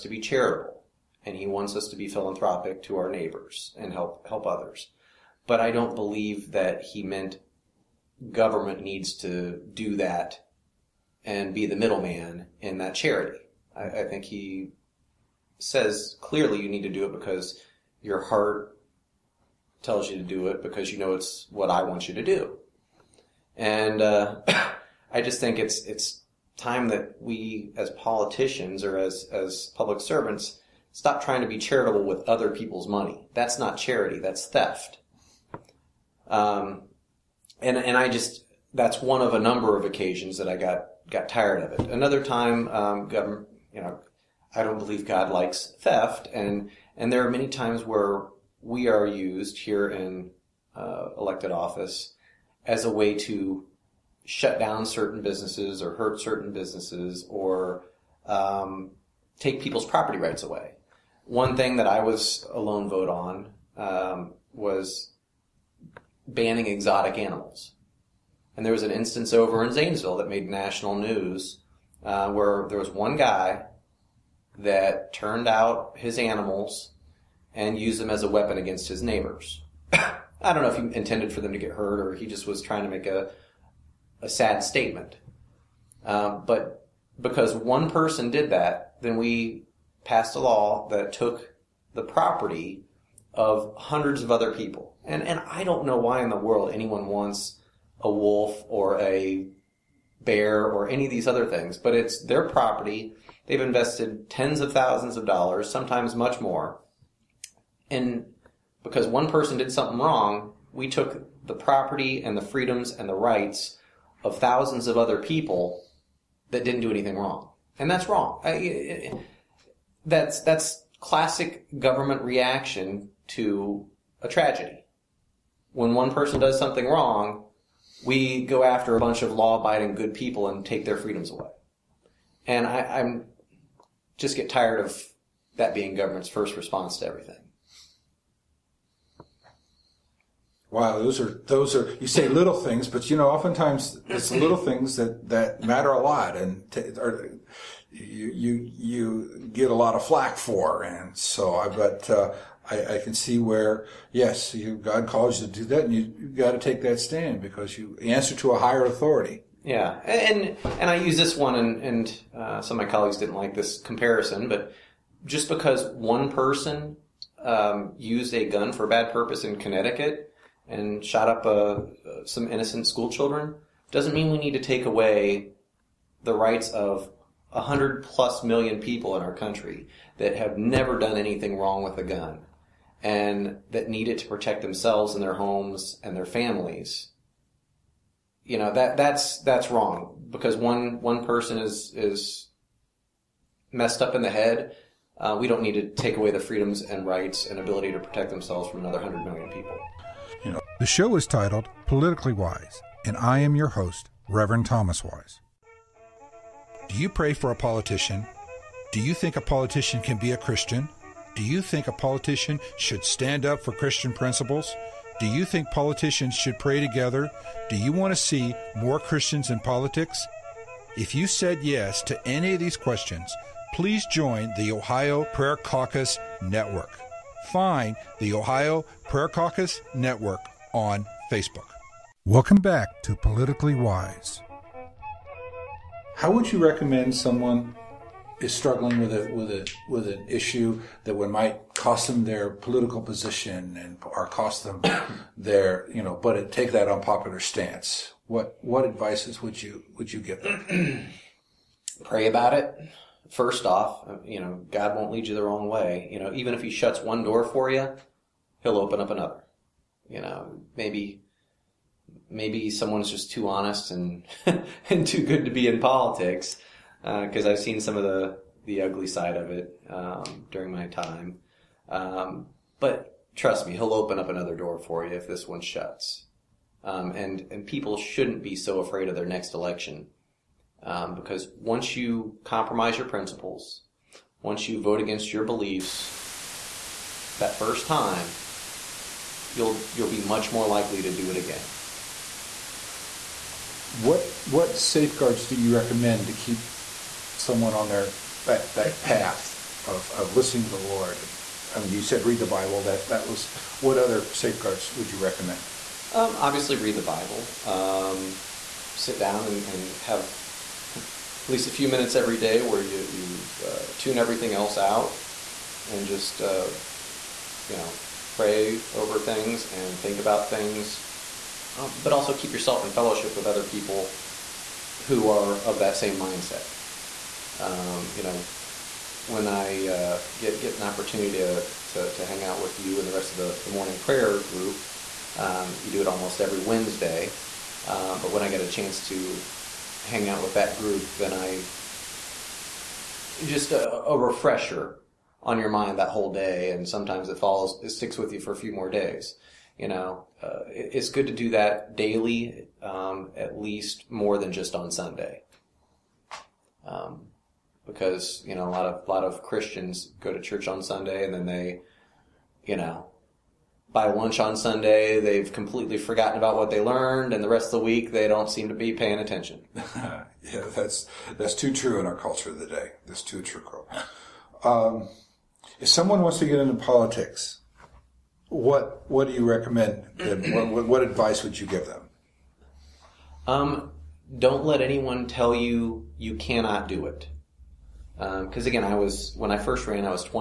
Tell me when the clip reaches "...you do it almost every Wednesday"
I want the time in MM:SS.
05:35.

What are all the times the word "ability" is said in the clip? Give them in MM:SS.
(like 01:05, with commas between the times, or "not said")
03:17.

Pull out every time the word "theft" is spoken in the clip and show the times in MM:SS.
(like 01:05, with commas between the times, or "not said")
00:34, 00:45.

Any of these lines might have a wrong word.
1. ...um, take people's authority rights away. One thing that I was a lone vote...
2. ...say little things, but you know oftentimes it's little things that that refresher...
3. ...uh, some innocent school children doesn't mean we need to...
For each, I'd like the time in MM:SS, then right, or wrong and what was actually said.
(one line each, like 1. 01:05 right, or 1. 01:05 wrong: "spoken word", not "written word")
1. 00:58 wrong: "property", not "authority"
2. 02:22 wrong: "matter", not "refresher"
3. 02:52 right.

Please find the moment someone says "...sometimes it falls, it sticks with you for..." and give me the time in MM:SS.
05:46.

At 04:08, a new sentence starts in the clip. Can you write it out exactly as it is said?
What what advices would you would you give them?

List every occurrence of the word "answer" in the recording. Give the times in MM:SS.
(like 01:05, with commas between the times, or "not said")
02:38.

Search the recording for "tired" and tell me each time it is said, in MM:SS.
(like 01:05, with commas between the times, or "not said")
00:41, 02:14.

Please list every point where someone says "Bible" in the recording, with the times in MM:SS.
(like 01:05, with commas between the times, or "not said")
05:02, 05:07.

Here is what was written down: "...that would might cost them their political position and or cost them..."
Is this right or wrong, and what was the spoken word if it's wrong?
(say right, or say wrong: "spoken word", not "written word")
right.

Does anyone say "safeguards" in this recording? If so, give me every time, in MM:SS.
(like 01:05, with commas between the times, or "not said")
04:54, 05:04.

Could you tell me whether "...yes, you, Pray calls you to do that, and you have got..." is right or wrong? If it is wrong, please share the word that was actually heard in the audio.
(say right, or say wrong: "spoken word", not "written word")
wrong: "God", not "Pray".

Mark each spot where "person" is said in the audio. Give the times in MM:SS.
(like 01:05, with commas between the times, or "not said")
01:27, 01:49, 02:06, 02:46, 03:11.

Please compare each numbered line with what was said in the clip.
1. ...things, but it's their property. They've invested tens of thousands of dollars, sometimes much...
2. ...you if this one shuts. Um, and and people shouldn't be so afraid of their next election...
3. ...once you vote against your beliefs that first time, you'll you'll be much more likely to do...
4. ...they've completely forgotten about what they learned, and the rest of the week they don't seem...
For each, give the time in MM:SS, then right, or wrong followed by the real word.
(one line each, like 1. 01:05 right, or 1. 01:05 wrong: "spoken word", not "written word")
1. 01:41 right
2. 04:35 right
3. 04:44 right
4. 06:05 right.